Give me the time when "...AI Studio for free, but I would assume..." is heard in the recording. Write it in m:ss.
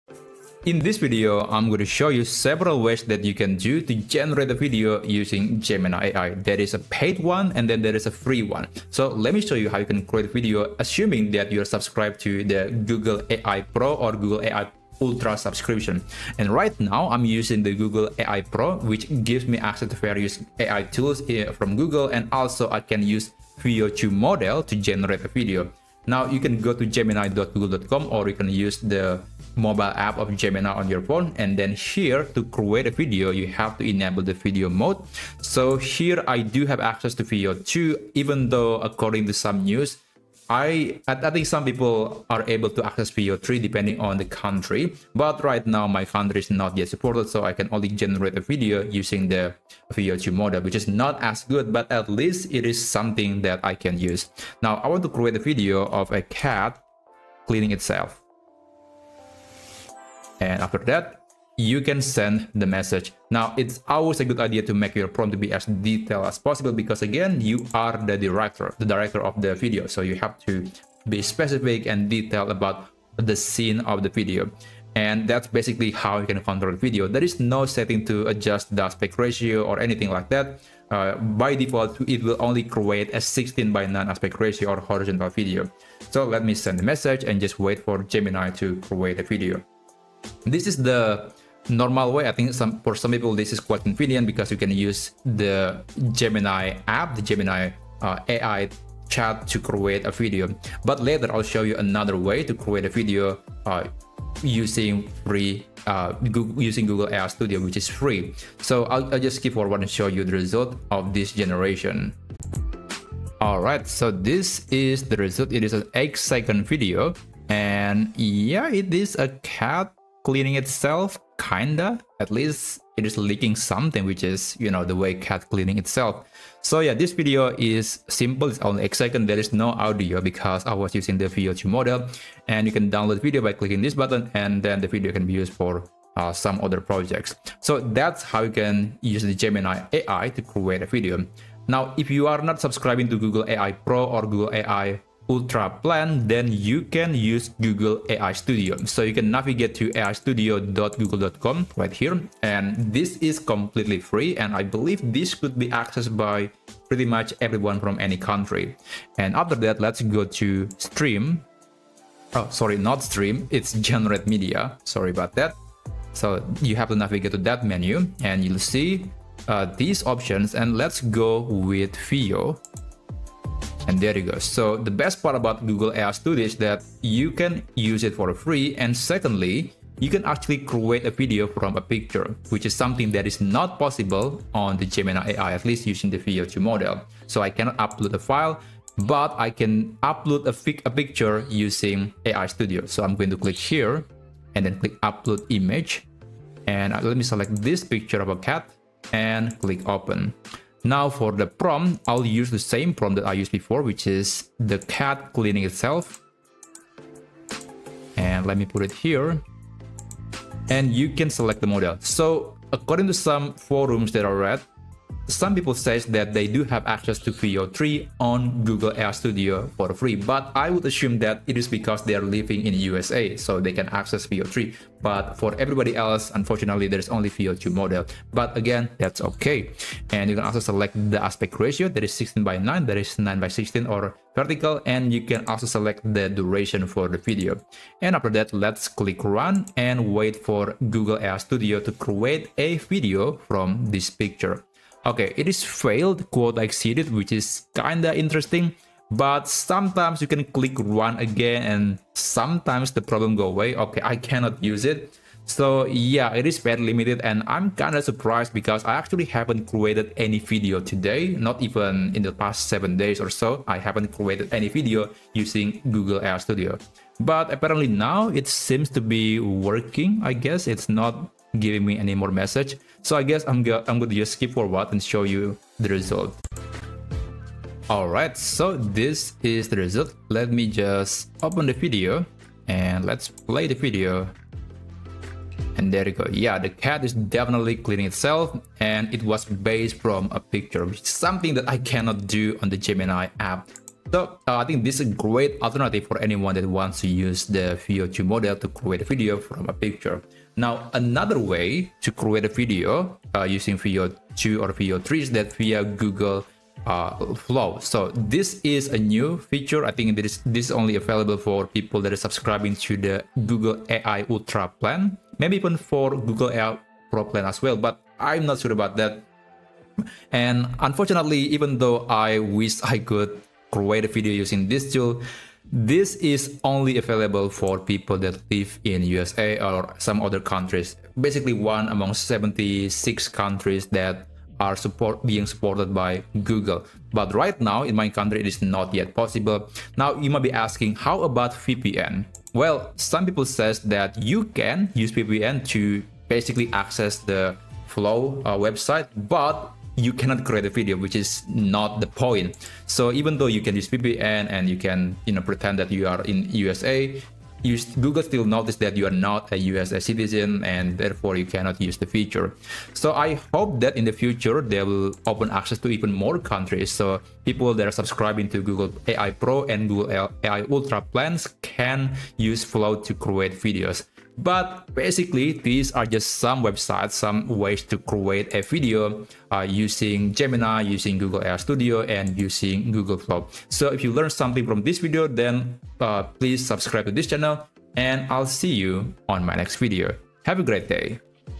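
3:38.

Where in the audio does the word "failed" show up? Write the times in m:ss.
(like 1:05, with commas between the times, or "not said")
4:05.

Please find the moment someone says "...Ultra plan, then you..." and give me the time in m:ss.
2:25.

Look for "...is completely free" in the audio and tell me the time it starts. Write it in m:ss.
2:33.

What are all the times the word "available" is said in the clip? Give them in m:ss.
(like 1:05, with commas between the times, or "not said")
5:10, 5:26.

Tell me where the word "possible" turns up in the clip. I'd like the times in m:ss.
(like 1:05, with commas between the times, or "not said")
1:06, 3:03, 5:39.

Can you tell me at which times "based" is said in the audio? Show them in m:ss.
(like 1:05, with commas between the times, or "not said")
4:49.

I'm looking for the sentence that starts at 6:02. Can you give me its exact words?
So I hope that in the future they will open access to even more countries.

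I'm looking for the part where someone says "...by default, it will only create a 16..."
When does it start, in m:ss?
1:21.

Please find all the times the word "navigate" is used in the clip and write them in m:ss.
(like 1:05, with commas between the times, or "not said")
2:29, 2:46.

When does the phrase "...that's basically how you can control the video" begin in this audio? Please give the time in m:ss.
1:15.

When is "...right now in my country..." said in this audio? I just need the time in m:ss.
5:37.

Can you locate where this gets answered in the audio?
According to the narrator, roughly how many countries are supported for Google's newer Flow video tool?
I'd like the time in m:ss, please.
5:32.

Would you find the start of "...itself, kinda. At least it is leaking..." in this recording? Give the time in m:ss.
2:00.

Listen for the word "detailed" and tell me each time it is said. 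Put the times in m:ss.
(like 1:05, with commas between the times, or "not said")
1:05, 1:12.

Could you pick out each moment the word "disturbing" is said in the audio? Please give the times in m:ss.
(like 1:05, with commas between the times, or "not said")
not said.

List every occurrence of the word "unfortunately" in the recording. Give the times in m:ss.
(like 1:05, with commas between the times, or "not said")
3:46, 5:20.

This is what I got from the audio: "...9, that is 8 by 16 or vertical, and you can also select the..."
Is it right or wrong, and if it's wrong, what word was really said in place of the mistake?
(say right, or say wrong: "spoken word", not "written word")
wrong: "9", not "8".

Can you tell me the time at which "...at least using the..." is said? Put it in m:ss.
3:05.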